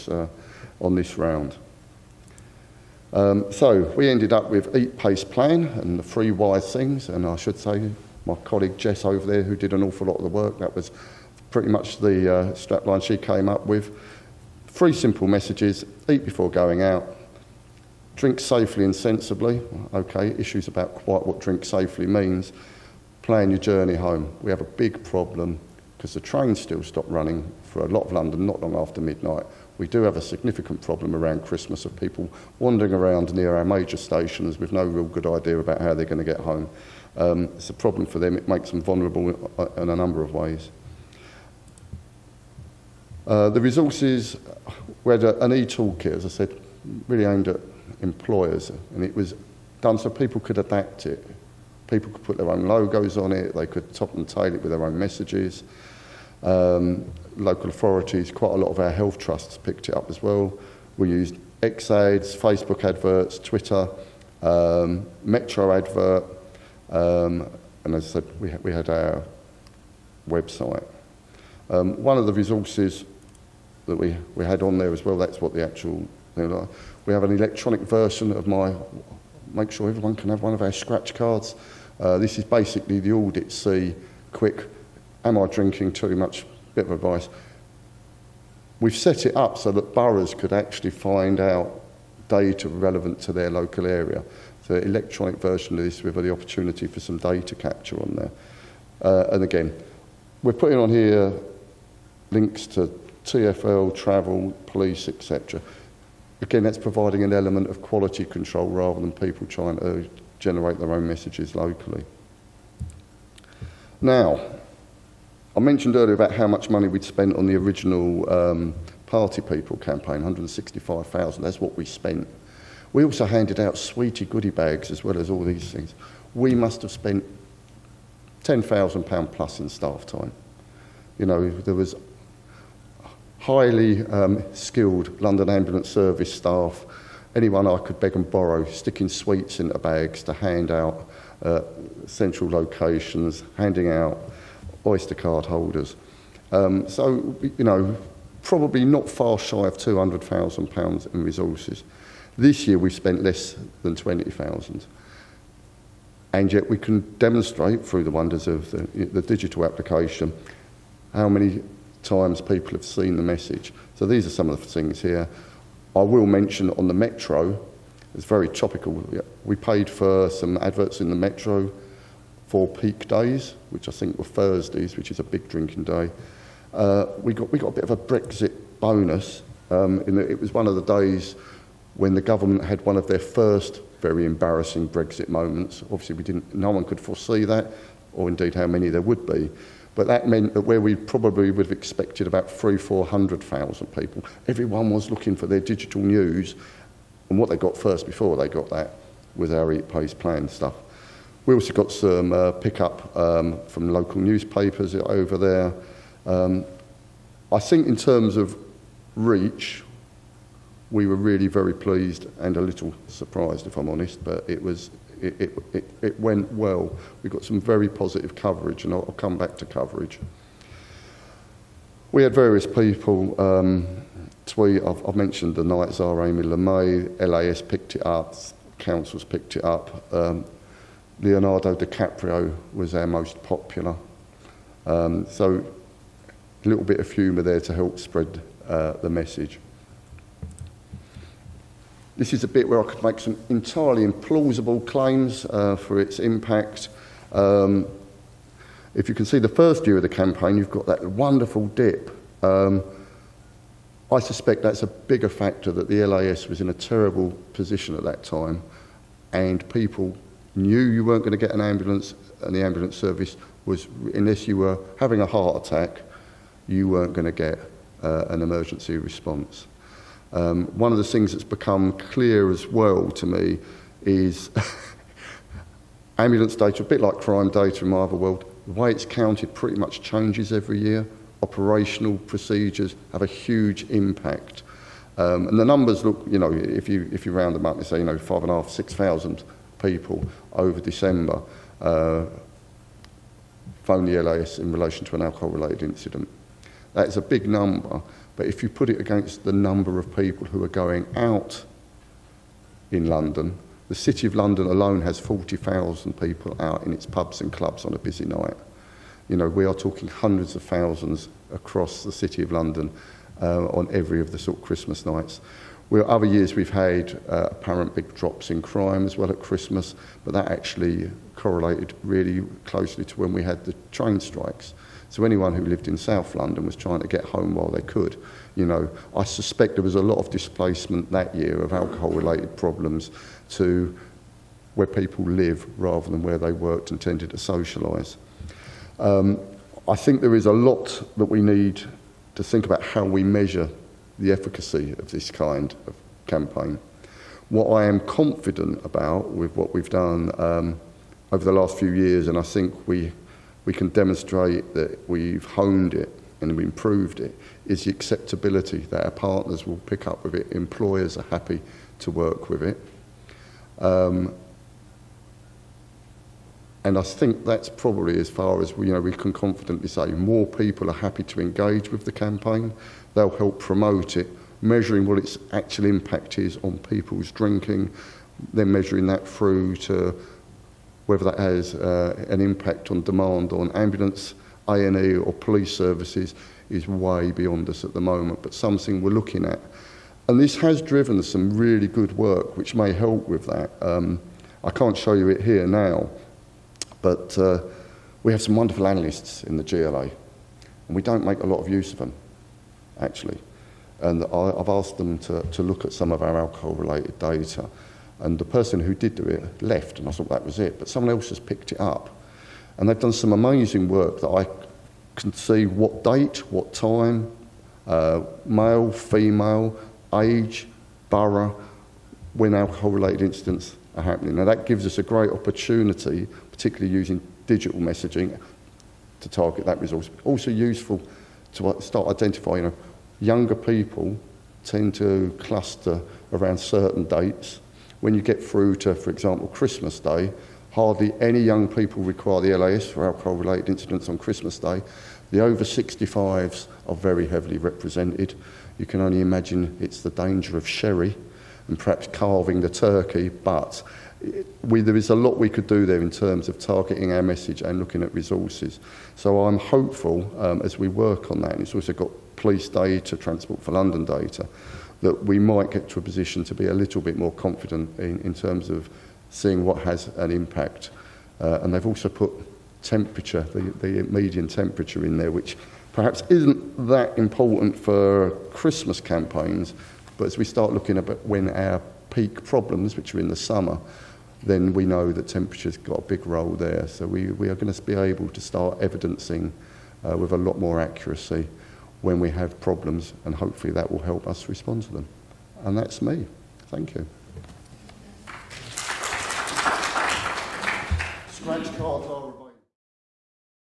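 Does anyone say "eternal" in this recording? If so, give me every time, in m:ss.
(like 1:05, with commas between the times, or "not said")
not said.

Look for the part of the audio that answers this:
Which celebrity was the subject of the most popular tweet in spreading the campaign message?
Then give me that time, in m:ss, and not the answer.
3:51.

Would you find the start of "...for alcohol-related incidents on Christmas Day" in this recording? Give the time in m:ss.
7:22.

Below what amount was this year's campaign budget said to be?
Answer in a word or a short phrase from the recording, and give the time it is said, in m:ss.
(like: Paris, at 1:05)
20,000, at 2:33.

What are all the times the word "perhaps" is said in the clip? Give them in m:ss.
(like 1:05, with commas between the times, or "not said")
7:31, 7:55.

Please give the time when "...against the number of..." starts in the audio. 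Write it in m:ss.
4:59.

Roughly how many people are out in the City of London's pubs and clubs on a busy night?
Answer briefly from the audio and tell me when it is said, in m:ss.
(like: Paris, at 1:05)
40,000, at 5:05.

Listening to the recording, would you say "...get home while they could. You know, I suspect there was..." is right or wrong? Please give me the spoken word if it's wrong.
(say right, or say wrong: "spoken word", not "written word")
right.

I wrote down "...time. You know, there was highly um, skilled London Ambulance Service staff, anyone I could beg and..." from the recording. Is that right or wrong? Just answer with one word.
right.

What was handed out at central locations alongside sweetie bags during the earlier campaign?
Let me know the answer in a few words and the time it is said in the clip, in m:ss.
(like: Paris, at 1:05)
Oyster card holders, at 2:24.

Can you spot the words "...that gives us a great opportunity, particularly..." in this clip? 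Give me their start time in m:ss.
7:04.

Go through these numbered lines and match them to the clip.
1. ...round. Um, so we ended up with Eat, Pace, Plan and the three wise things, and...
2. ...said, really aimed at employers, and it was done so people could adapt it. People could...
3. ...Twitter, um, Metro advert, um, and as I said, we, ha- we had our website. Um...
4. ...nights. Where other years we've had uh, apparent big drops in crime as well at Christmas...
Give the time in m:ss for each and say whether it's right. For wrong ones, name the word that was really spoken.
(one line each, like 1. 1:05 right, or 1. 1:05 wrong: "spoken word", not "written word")
1. 0:01 right
2. 0:46 right
3. 1:03 right
4. 5:15 right.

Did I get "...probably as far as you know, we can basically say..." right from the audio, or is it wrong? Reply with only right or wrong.
wrong.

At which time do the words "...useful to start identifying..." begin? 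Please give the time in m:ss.
7:10.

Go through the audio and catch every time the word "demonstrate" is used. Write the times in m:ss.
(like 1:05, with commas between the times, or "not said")
2:37, 5:53.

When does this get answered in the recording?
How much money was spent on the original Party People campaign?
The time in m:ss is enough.
2:00.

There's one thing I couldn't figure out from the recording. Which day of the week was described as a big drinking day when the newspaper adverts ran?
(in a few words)
Thursdays.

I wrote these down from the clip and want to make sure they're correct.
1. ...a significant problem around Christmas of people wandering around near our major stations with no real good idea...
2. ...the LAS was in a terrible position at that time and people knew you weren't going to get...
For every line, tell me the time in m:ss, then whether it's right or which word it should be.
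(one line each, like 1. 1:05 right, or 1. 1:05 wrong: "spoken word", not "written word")
1. 0:30 right
2. 4:15 right.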